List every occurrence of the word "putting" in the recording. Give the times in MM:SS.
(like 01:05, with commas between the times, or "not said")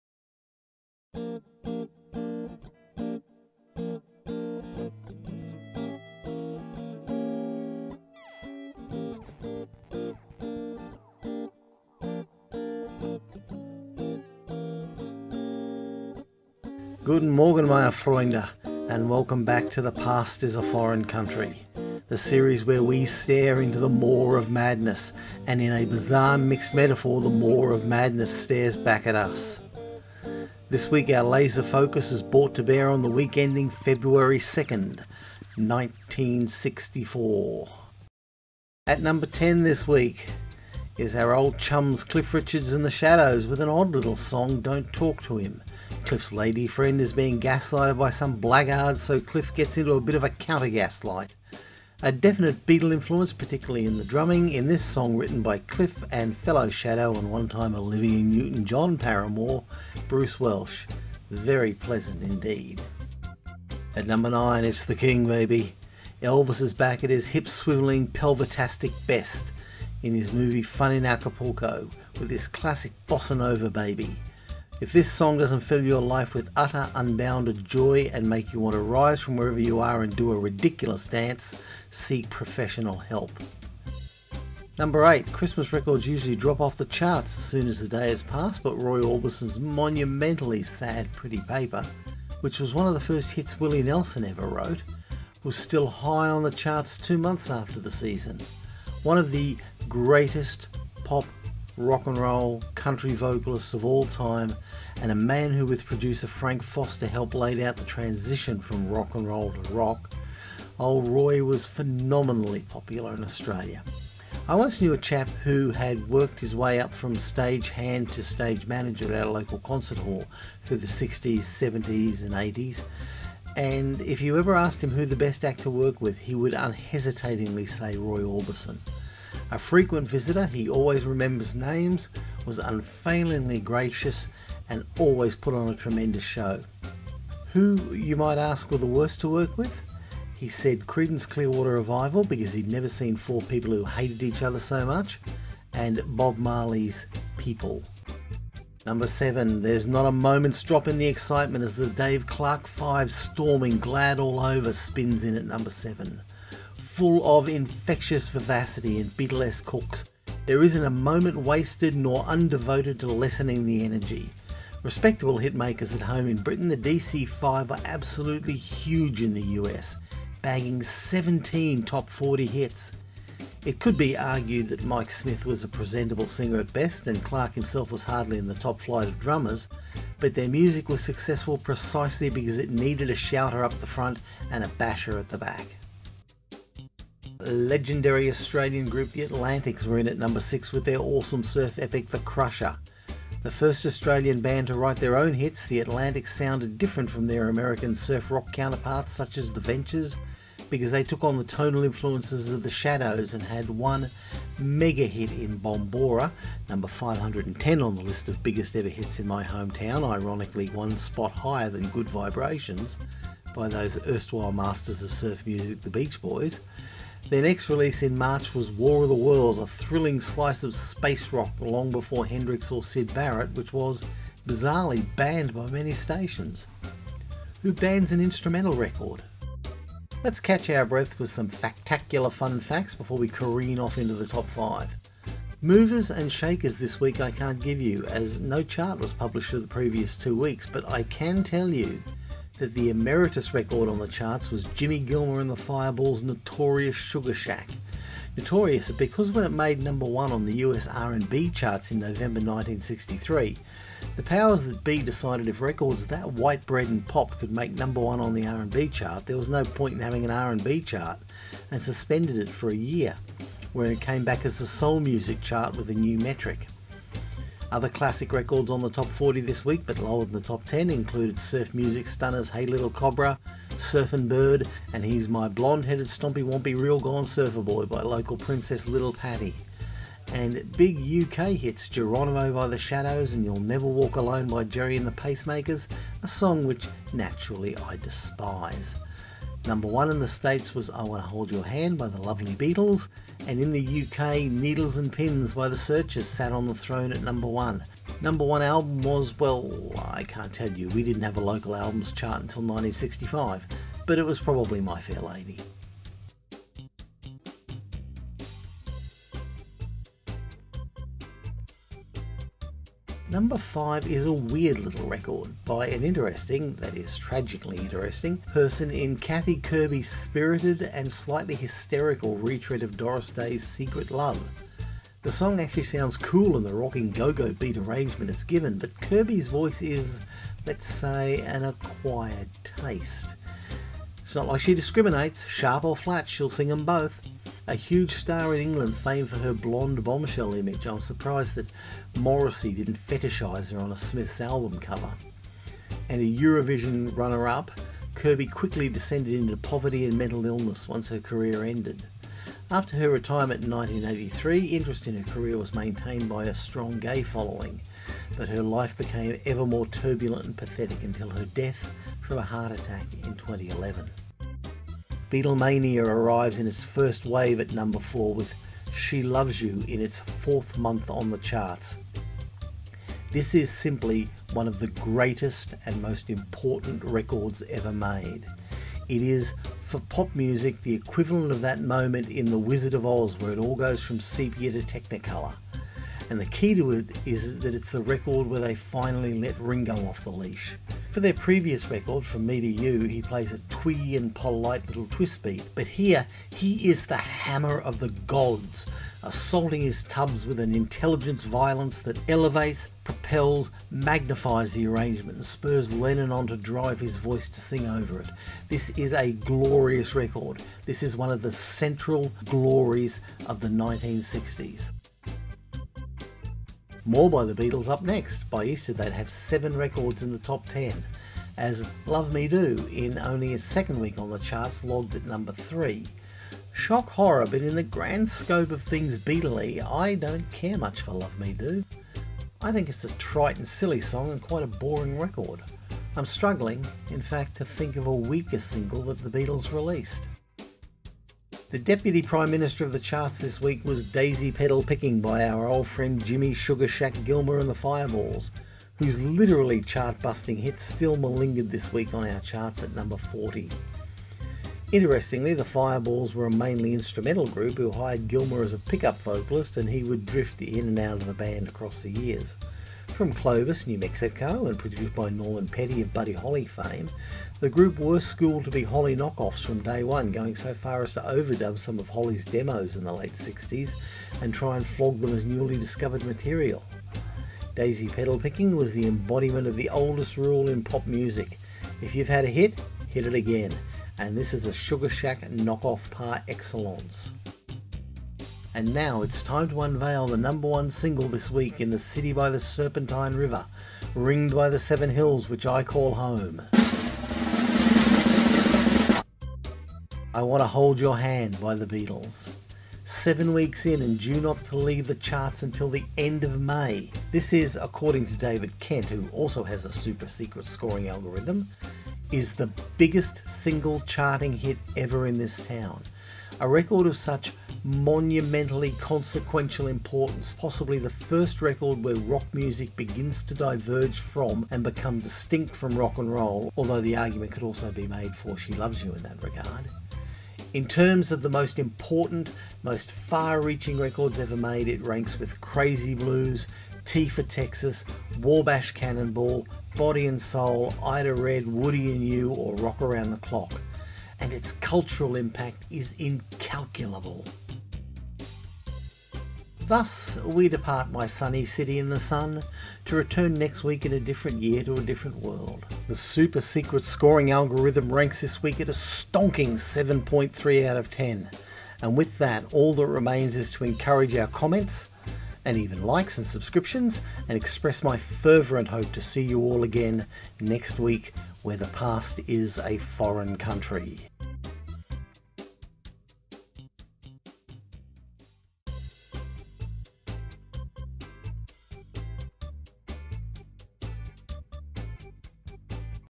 not said.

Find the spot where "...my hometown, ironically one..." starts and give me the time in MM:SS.
03:29.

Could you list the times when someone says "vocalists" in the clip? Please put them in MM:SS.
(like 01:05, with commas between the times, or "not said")
01:43, 07:39.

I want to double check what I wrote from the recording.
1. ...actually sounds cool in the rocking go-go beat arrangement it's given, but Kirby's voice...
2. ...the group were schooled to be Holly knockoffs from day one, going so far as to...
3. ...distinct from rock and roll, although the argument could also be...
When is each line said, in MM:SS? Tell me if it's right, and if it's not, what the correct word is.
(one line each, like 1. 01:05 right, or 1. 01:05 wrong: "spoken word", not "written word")
1. 05:25 right
2. 07:47 right
3. 08:45 right.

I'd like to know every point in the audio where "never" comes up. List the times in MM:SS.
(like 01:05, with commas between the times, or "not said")
02:22, 04:43.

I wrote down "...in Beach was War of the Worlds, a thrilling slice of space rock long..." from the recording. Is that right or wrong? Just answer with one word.
wrong.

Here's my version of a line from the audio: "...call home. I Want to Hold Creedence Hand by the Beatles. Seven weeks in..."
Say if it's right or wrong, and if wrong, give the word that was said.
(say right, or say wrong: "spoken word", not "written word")
wrong: "Your", not "Creedence".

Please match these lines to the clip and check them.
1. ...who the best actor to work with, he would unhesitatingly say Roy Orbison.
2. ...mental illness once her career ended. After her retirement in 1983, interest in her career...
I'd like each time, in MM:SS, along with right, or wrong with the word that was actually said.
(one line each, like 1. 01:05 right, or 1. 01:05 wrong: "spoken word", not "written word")
1. 02:04 right
2. 05:50 right.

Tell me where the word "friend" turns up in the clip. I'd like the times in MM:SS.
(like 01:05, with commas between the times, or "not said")
00:46, 07:25.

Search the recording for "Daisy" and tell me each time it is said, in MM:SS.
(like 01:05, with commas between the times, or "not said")
07:24, 07:57.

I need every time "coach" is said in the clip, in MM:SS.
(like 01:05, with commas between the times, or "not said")
not said.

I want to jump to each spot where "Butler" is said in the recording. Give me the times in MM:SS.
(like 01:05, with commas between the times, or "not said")
not said.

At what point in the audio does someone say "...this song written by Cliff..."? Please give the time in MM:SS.
00:54.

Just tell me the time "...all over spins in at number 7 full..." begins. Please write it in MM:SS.
02:34.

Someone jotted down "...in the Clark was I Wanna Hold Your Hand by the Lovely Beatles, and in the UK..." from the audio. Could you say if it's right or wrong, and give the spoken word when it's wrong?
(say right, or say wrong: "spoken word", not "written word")
wrong: "States", not "Clark".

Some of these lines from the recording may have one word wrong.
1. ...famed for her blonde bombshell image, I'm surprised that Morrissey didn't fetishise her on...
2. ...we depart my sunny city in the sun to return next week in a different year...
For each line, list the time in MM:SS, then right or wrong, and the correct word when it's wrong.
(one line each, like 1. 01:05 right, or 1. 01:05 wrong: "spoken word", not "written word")
1. 05:38 right
2. 09:10 right.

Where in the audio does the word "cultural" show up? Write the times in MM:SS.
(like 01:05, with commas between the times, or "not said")
09:04.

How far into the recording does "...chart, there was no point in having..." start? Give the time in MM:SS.
04:18.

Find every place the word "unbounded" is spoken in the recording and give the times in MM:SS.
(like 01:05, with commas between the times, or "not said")
01:16.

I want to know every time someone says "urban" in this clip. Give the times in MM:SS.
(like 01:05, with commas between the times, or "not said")
not said.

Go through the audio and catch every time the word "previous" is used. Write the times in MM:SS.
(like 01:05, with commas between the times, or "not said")
03:59, 06:31.